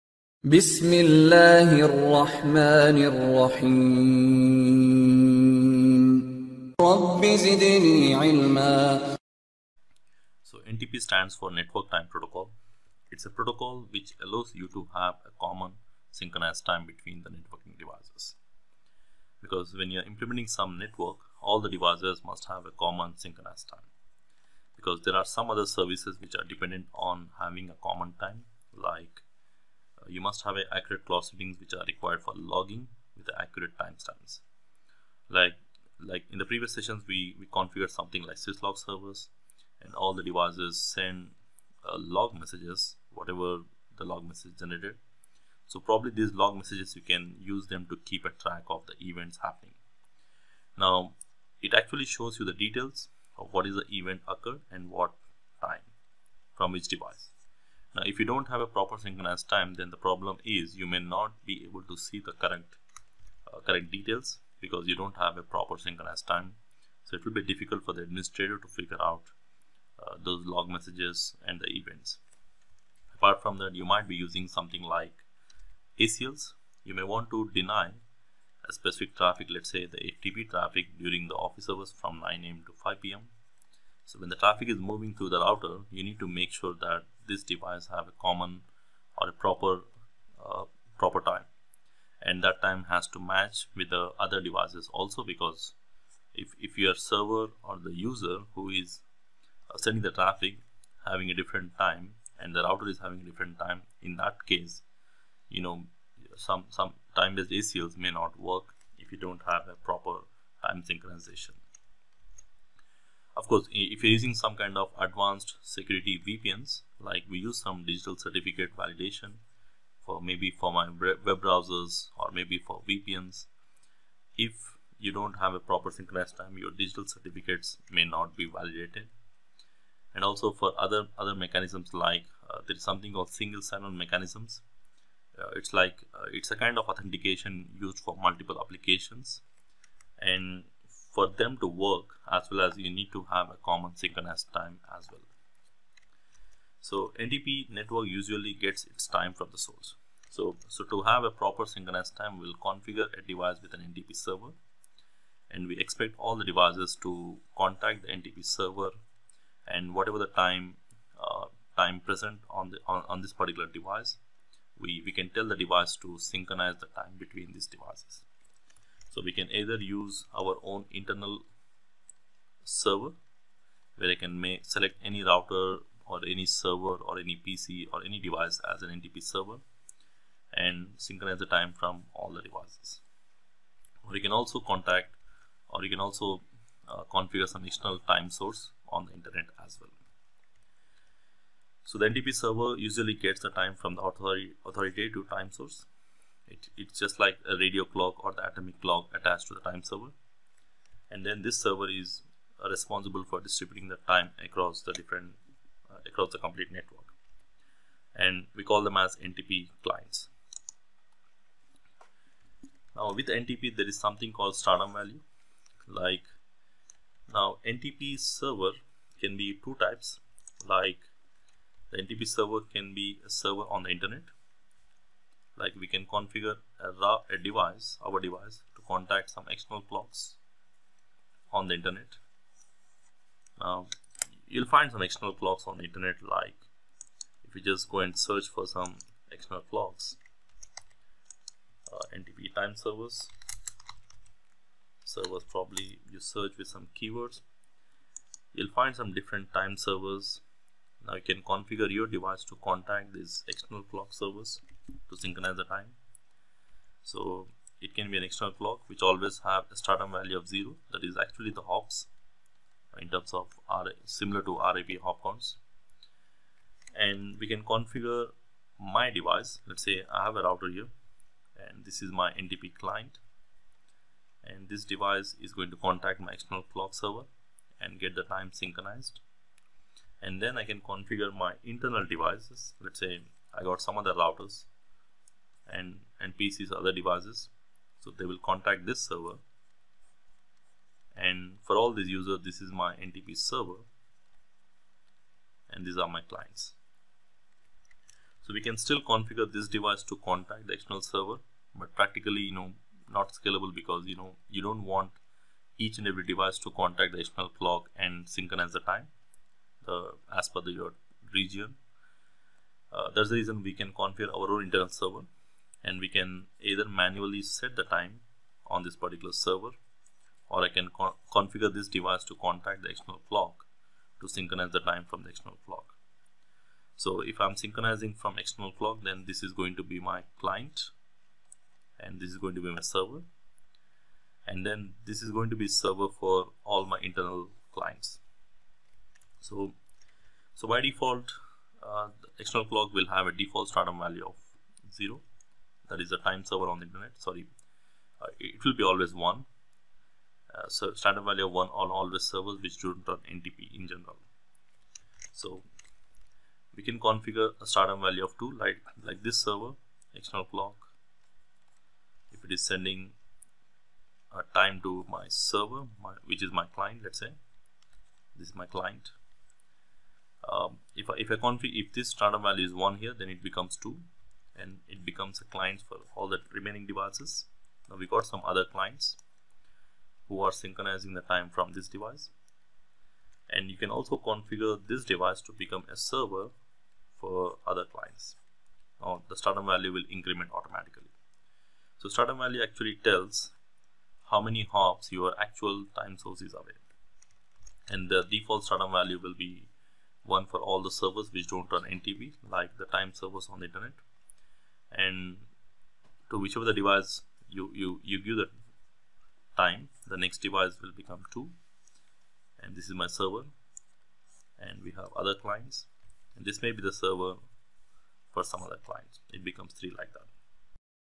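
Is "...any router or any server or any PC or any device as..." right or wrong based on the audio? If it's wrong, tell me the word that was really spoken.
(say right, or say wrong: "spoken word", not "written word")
right.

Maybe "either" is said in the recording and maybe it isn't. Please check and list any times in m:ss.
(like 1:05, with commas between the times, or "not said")
2:49, 5:16.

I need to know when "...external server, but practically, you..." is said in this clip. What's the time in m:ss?
5:00.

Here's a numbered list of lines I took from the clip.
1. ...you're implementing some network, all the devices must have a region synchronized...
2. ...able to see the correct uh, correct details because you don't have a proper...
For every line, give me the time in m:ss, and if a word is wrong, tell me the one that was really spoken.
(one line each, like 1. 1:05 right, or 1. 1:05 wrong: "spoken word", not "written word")
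1. 0:19 wrong: "common", not "region"
2. 1:01 right.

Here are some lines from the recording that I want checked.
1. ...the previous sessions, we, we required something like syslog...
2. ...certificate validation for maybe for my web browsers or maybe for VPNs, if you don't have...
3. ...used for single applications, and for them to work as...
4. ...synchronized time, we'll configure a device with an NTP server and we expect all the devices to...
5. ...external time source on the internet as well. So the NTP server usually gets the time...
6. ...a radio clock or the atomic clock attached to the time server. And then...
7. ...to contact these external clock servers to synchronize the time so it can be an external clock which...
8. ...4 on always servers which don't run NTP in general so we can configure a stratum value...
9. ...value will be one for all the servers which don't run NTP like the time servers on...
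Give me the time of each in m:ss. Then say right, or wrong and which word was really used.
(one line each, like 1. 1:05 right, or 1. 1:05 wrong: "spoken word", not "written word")
1. 0:36 wrong: "configured", not "required"
2. 1:58 right
3. 2:17 wrong: "multiple", not "single"
4. 2:31 right
5. 3:07 right
6. 3:17 right
7. 4:12 right
8. 5:51 wrong: "1", not "4"
9. 6:38 right.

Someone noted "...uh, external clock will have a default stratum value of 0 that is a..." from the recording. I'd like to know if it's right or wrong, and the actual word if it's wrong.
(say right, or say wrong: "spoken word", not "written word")
right.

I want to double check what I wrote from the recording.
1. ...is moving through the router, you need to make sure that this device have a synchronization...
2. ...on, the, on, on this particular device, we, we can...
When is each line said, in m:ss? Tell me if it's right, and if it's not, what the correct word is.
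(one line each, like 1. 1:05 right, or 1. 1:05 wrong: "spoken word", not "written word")
1. 1:24 wrong: "common", not "synchronization"
2. 2:42 right.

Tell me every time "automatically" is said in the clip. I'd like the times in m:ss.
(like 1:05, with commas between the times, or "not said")
6:30.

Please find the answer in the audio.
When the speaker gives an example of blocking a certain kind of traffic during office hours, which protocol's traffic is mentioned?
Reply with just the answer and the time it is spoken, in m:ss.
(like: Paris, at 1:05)
FTP, at 1:19.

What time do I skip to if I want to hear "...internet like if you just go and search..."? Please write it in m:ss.
3:55.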